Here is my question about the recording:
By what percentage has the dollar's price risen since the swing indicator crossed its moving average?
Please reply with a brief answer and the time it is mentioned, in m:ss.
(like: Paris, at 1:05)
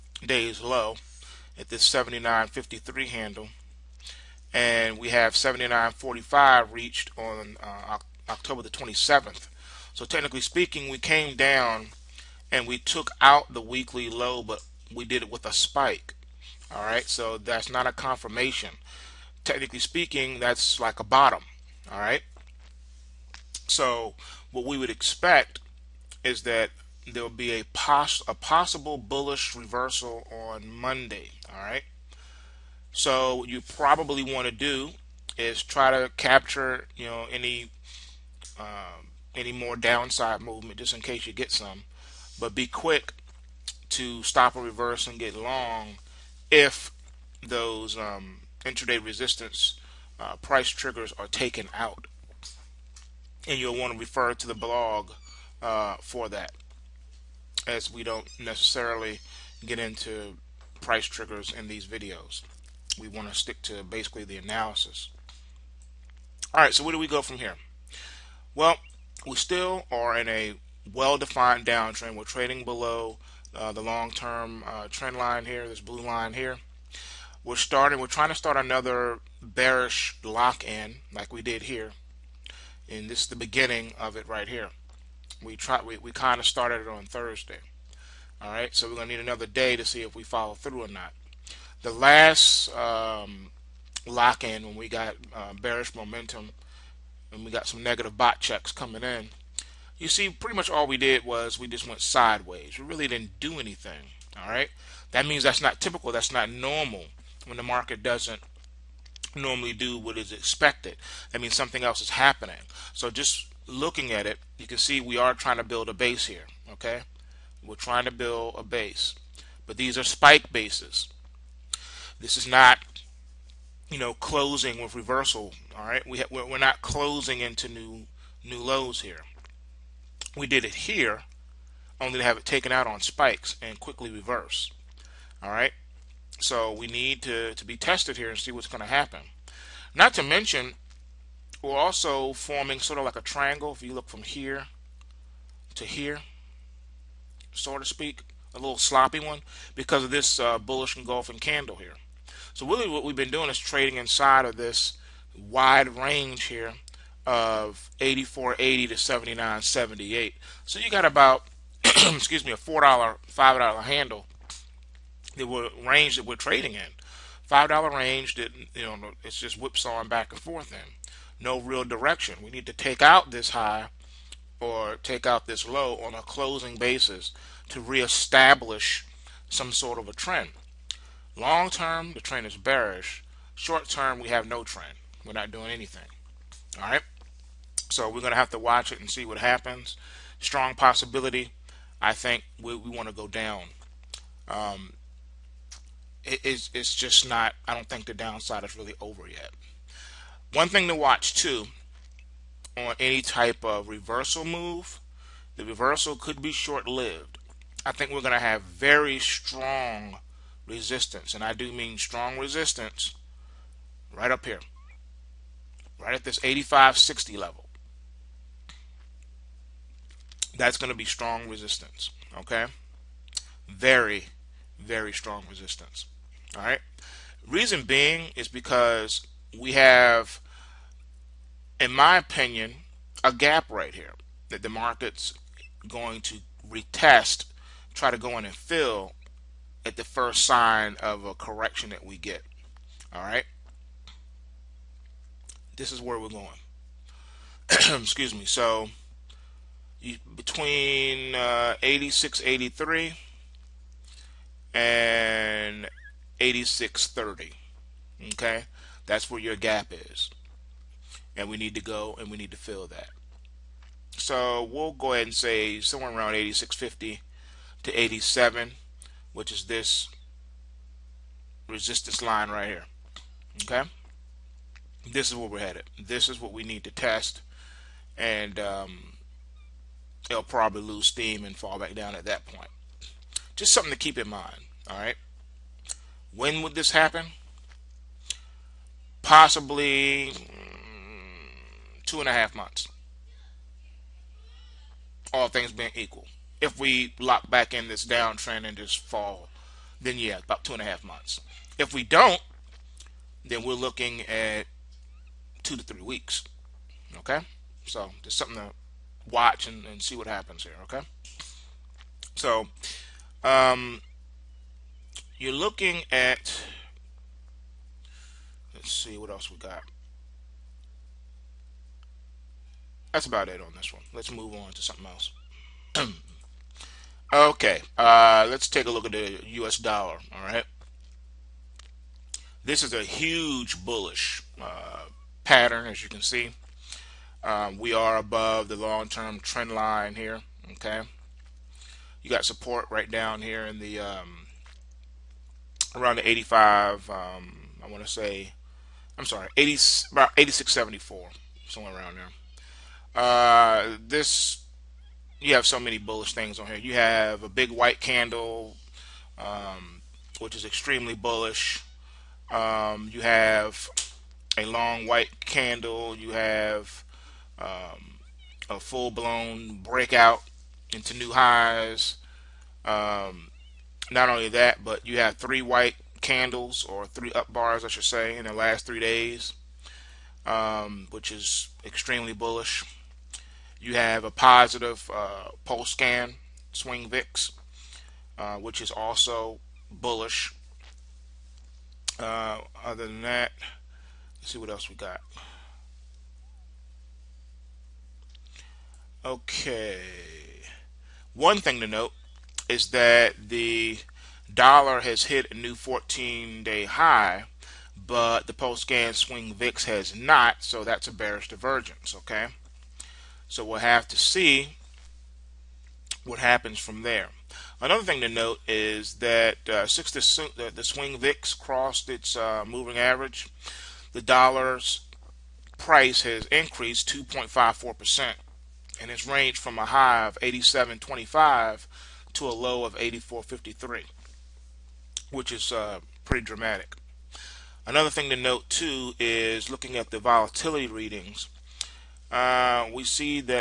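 2.54%, at 7:07.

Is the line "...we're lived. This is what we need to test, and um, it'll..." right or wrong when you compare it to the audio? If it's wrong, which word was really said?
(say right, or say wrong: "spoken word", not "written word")
wrong: "headed", not "lived".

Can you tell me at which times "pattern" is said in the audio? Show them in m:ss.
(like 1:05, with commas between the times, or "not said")
5:35.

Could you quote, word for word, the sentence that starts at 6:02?
Um, you have a long white candle.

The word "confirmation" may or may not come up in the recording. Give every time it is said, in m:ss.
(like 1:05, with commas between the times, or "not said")
0:17.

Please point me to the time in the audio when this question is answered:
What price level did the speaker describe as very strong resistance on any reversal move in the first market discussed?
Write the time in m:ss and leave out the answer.
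3:36.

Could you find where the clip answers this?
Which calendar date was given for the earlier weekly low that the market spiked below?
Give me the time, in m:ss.
0:08.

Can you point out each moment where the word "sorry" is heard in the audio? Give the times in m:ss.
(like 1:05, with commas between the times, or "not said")
5:49.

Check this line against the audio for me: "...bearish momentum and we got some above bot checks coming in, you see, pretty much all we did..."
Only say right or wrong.
wrong.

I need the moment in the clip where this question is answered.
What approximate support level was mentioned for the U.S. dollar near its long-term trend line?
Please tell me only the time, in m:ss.
5:50.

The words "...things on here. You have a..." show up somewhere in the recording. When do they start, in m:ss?
5:56.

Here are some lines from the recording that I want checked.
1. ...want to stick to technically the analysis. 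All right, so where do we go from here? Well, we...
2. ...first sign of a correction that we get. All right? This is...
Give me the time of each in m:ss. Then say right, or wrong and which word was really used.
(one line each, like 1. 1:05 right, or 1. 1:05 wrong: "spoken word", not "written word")
1. 1:03 wrong: "basically", not "technically"
2. 4:00 right.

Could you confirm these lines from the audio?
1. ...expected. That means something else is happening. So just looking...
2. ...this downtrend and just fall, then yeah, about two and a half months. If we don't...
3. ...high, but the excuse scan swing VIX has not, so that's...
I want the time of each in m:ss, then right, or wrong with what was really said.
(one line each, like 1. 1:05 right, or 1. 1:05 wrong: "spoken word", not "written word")
1. 1:50 right
2. 4:57 right
3. 6:46 wrong: "pulse", not "excuse".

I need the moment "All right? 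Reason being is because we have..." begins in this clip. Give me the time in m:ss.
3:46.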